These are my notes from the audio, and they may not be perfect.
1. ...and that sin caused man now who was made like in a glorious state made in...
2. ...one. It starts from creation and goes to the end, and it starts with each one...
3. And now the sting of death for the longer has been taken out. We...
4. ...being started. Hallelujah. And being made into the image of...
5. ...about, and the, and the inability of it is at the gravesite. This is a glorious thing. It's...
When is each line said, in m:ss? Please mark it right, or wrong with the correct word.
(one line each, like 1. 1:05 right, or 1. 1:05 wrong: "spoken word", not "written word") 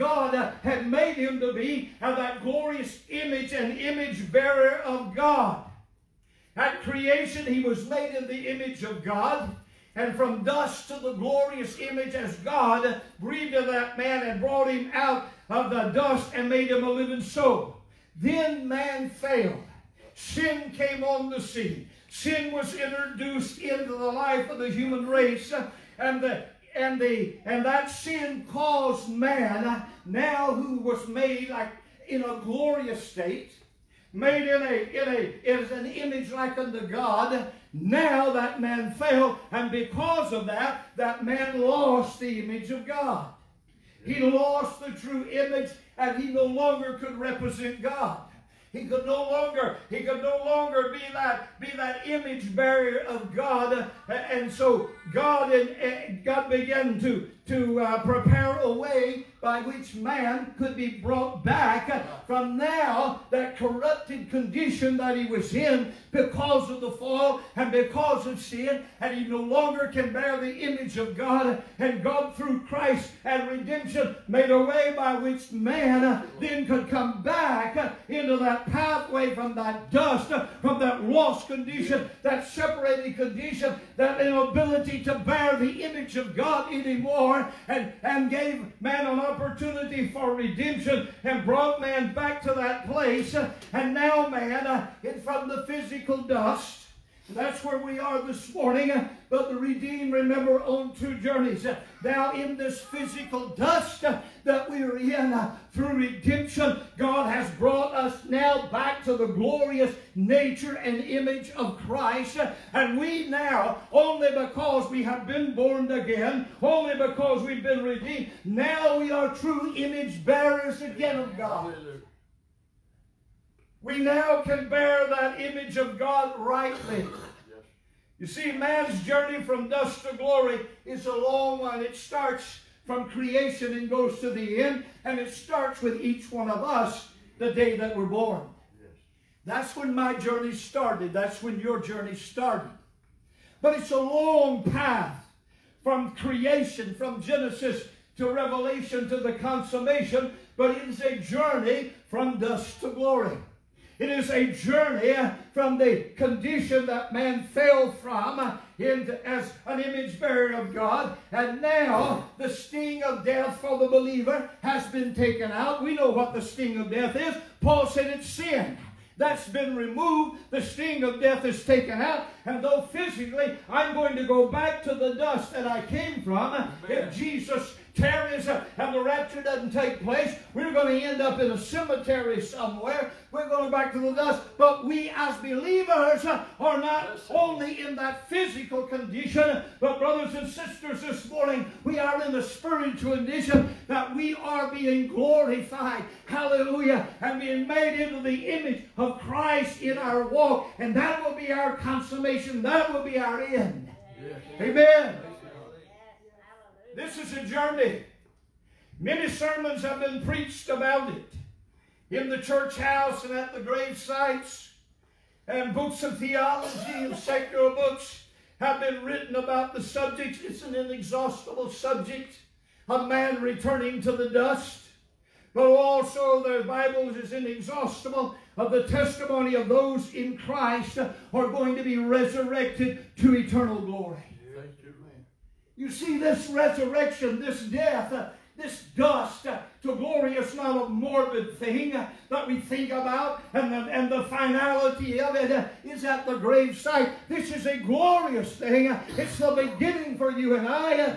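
1. 0:27 right
2. 2:11 right
3. 2:41 wrong: "believer", not "longer"
4. 3:14 wrong: "glorified", not "started"
5. 4:02 wrong: "finality", not "inability".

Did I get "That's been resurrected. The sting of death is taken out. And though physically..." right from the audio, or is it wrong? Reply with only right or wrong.
wrong.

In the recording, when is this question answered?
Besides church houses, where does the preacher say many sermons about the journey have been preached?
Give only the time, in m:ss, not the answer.
3:33.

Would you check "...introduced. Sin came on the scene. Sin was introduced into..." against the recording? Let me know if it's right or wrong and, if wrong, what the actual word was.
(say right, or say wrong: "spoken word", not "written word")
wrong: "failed", not "introduced".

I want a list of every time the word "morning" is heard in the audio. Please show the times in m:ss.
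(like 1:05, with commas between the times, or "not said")
1:38, 3:11.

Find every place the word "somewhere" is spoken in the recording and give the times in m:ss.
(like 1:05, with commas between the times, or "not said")
3:02.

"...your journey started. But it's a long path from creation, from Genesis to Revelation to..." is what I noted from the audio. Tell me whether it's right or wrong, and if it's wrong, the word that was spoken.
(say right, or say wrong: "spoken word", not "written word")
right.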